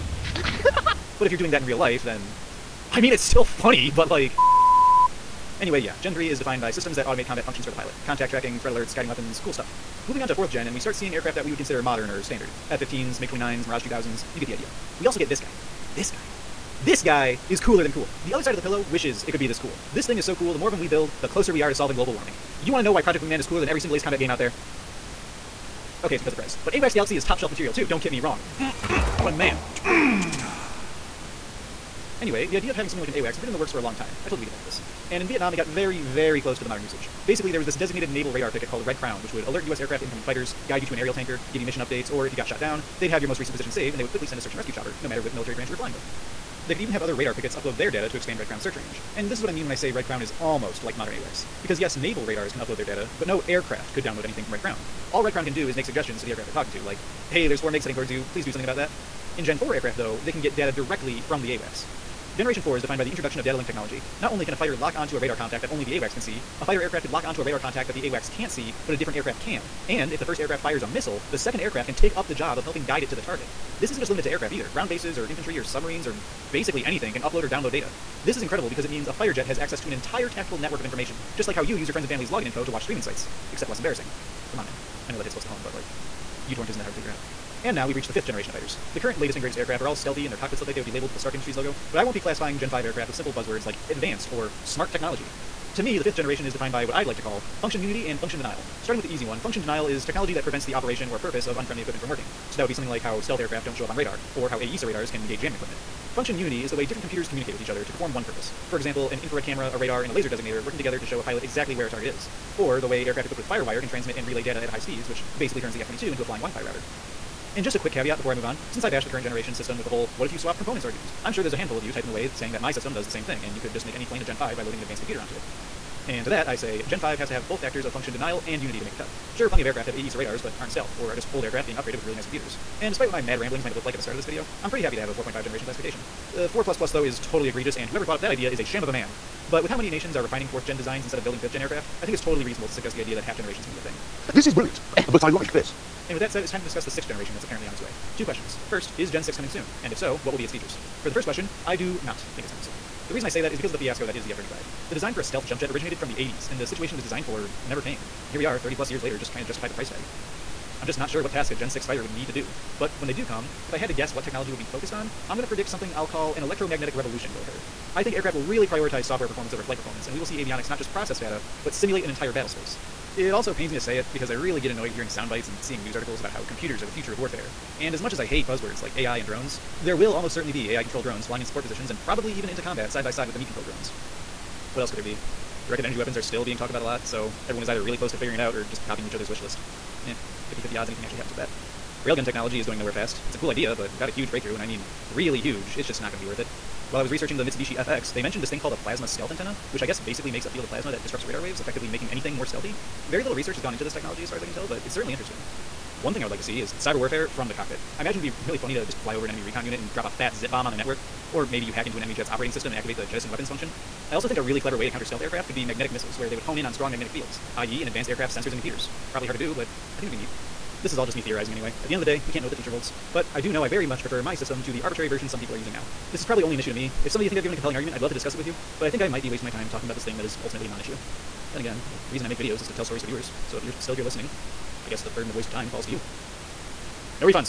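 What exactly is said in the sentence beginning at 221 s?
At the end of the day, we can't know what the future holds.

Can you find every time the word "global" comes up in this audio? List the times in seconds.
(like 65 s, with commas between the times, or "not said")
21 s.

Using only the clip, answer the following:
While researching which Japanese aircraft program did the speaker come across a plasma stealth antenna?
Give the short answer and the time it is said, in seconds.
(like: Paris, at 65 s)
Mitsubishi FX, at 197 s.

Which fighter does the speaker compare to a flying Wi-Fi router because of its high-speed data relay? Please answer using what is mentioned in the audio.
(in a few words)
F-22.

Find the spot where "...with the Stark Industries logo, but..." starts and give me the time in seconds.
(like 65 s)
91 s.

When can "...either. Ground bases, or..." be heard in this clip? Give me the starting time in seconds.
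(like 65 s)
74 s.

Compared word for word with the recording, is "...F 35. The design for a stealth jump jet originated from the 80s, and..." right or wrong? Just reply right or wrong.
right.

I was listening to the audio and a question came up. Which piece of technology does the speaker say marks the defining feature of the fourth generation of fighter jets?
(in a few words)
data link technology.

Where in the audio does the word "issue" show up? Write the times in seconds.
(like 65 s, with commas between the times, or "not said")
226 s, 230 s.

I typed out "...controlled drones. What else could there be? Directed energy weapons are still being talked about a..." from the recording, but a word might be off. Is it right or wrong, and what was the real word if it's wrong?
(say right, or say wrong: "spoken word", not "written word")
right.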